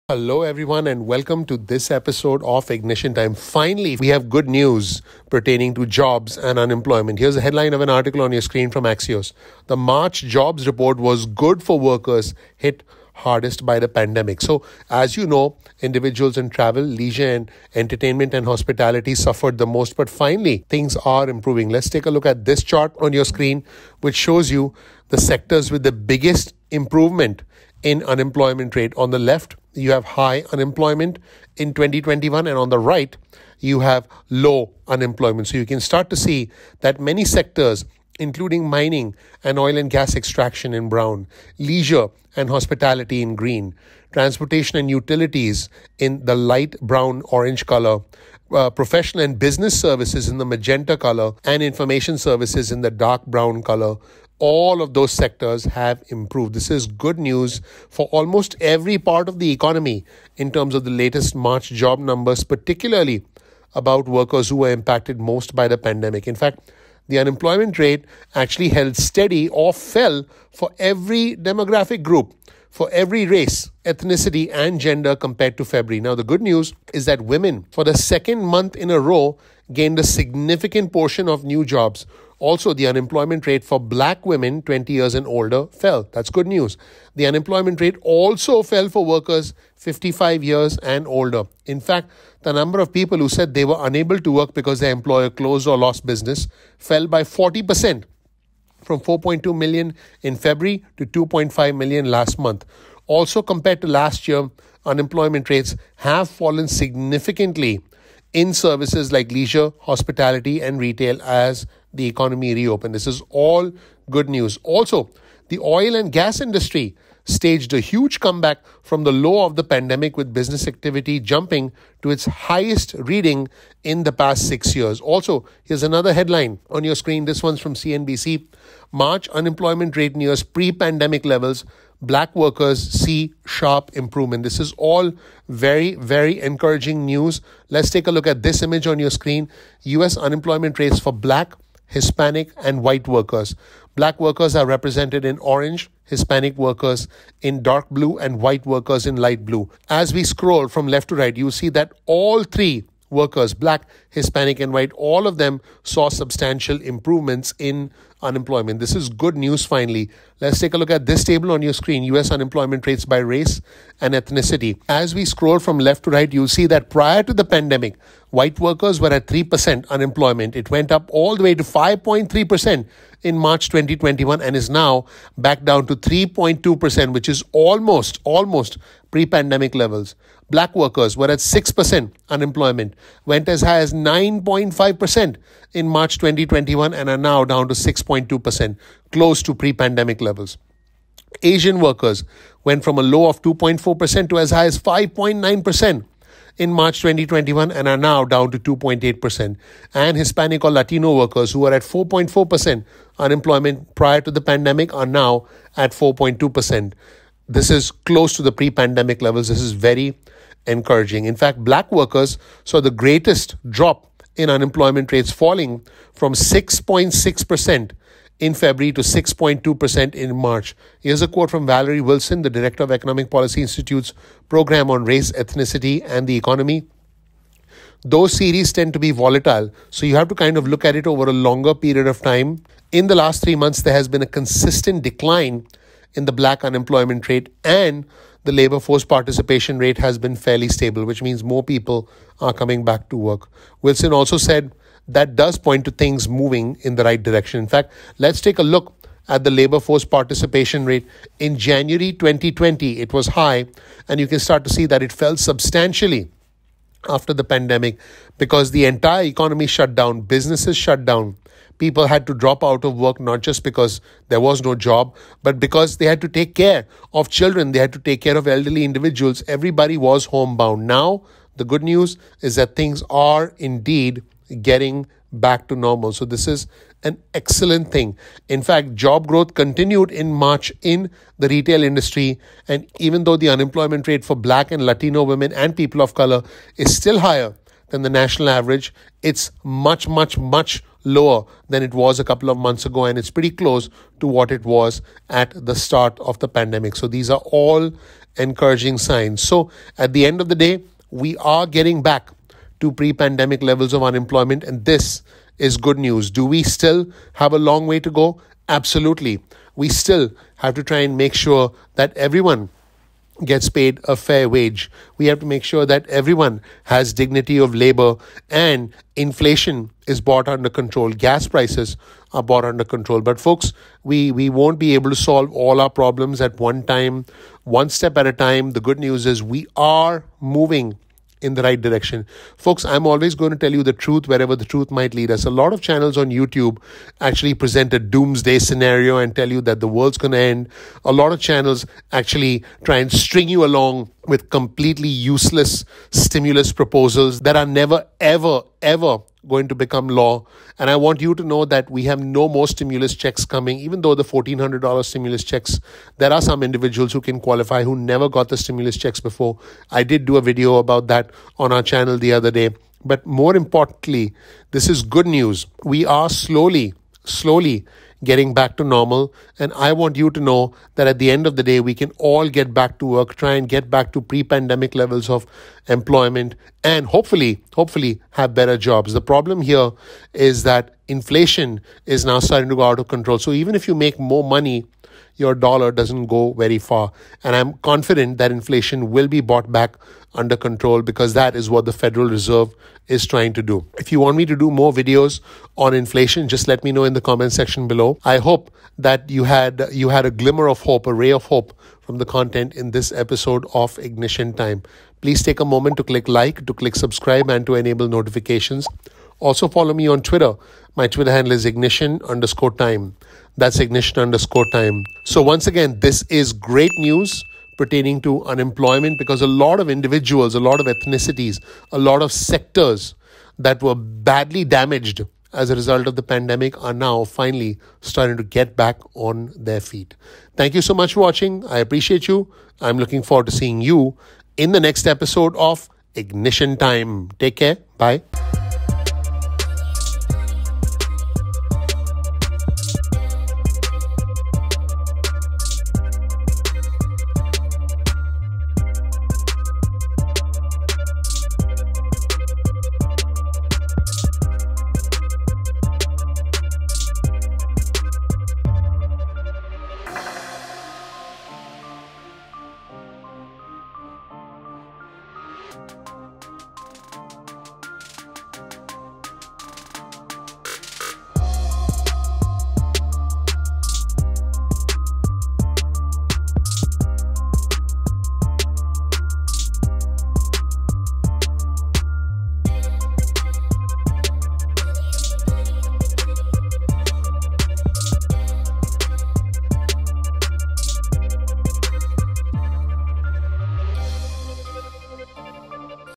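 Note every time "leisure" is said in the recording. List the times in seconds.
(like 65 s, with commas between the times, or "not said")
16 s, 41 s, 109 s.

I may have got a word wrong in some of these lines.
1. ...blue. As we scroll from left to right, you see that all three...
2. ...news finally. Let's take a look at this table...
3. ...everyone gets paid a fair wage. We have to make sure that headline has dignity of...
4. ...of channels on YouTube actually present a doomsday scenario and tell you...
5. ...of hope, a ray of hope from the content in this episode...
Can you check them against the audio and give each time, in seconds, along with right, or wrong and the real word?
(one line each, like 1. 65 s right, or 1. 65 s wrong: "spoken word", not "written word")
1. 149 s right
2. 159 s right
3. 312 s wrong: "everyone", not "headline"
4. 335 s right
5. 400 s right.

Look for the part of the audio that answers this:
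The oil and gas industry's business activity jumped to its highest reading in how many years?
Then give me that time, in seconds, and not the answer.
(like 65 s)
124 s.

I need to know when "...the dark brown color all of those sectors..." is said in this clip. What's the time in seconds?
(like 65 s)
52 s.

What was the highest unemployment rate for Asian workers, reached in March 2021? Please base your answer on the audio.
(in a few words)
5.9%.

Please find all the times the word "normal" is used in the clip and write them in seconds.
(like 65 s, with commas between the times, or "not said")
275 s, 368 s.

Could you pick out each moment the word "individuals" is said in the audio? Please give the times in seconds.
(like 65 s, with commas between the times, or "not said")
15 s, 268 s, 356 s, 419 s.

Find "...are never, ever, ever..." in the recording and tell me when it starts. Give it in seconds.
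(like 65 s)
347 s.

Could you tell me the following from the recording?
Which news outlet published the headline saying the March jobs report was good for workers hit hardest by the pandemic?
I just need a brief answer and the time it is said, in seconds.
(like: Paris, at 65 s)
Axios, at 8 s.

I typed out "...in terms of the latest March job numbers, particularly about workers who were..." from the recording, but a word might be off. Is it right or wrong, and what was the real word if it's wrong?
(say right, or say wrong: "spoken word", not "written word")
right.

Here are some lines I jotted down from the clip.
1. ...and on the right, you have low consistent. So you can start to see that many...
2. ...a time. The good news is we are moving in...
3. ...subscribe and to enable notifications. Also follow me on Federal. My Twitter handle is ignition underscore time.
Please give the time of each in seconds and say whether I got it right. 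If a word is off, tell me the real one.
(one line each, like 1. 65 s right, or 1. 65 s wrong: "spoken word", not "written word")
1. 32 s wrong: "unemployment", not "consistent"
2. 328 s right
3. 406 s wrong: "Twitter", not "Federal".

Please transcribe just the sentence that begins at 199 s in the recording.
And Hispanic or Latino workers who were at 4.4% unemployment prior to the pandemic are now at 4.2%.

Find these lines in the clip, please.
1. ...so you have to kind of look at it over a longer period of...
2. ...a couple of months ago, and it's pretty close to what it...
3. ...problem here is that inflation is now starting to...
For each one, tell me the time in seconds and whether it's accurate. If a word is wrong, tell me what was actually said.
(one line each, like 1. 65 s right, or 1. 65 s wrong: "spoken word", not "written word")
1. 229 s right
2. 292 s right
3. 379 s right.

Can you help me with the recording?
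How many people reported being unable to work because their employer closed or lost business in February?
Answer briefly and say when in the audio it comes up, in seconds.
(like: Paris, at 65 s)
4.2 million, at 99 s.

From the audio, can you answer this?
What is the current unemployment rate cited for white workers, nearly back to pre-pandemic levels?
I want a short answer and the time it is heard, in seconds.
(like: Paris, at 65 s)
3.2%, at 175 s.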